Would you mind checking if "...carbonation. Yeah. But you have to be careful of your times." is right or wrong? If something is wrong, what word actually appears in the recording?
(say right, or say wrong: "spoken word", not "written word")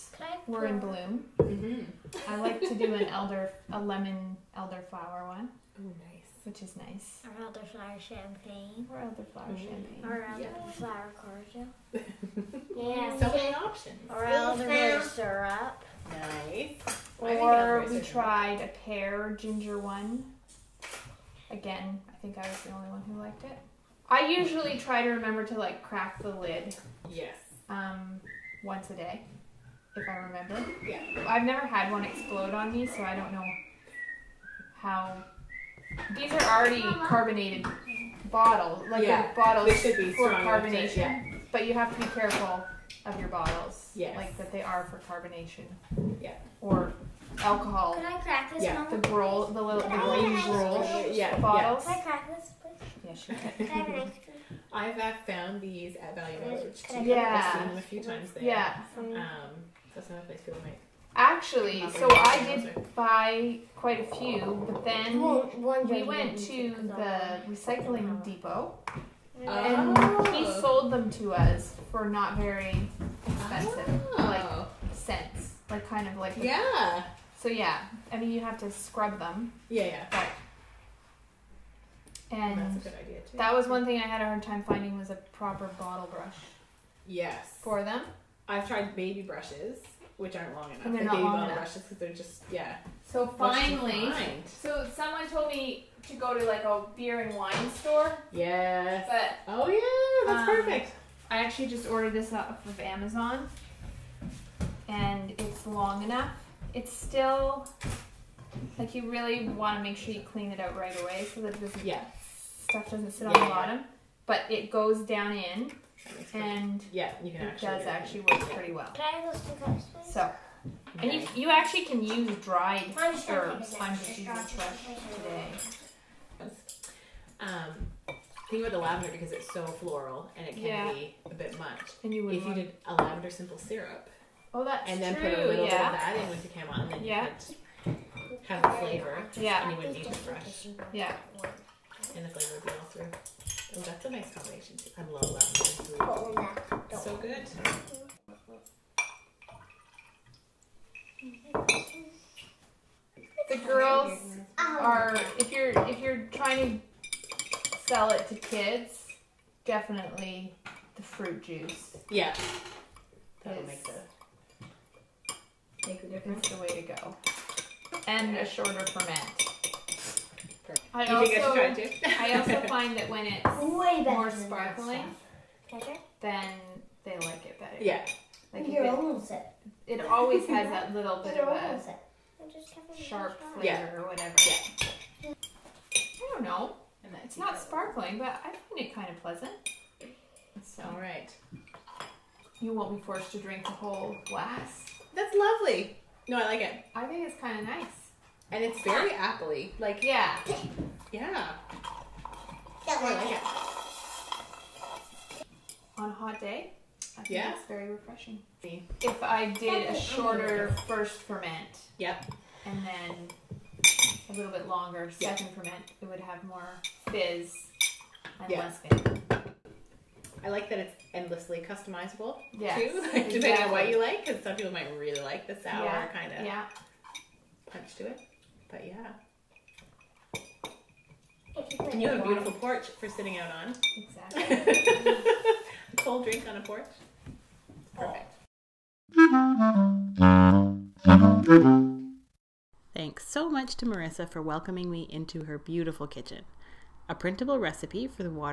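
wrong: "bottles", not "times".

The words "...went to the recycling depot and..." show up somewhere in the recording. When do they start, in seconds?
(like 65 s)
66 s.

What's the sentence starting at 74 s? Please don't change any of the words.
like cents, like kind of like yeah.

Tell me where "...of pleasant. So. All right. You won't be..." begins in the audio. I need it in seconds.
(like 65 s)
189 s.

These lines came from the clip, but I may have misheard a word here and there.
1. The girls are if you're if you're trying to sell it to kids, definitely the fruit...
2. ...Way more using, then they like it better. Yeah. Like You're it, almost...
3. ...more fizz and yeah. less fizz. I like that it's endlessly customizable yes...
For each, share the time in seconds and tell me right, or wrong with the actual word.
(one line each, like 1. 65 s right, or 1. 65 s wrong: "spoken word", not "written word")
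1. 153 s right
2. 173 s wrong: "sparkling", not "using"
3. 216 s right.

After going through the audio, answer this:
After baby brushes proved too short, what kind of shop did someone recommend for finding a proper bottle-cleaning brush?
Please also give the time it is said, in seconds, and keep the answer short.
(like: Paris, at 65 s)
a beer and wine store, at 96 s.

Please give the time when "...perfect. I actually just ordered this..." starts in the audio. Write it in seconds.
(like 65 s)
100 s.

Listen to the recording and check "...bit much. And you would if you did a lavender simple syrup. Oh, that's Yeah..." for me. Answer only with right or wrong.
wrong.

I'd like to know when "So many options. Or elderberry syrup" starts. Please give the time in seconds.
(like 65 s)
13 s.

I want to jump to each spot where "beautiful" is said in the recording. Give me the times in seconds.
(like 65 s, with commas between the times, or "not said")
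232 s, 245 s.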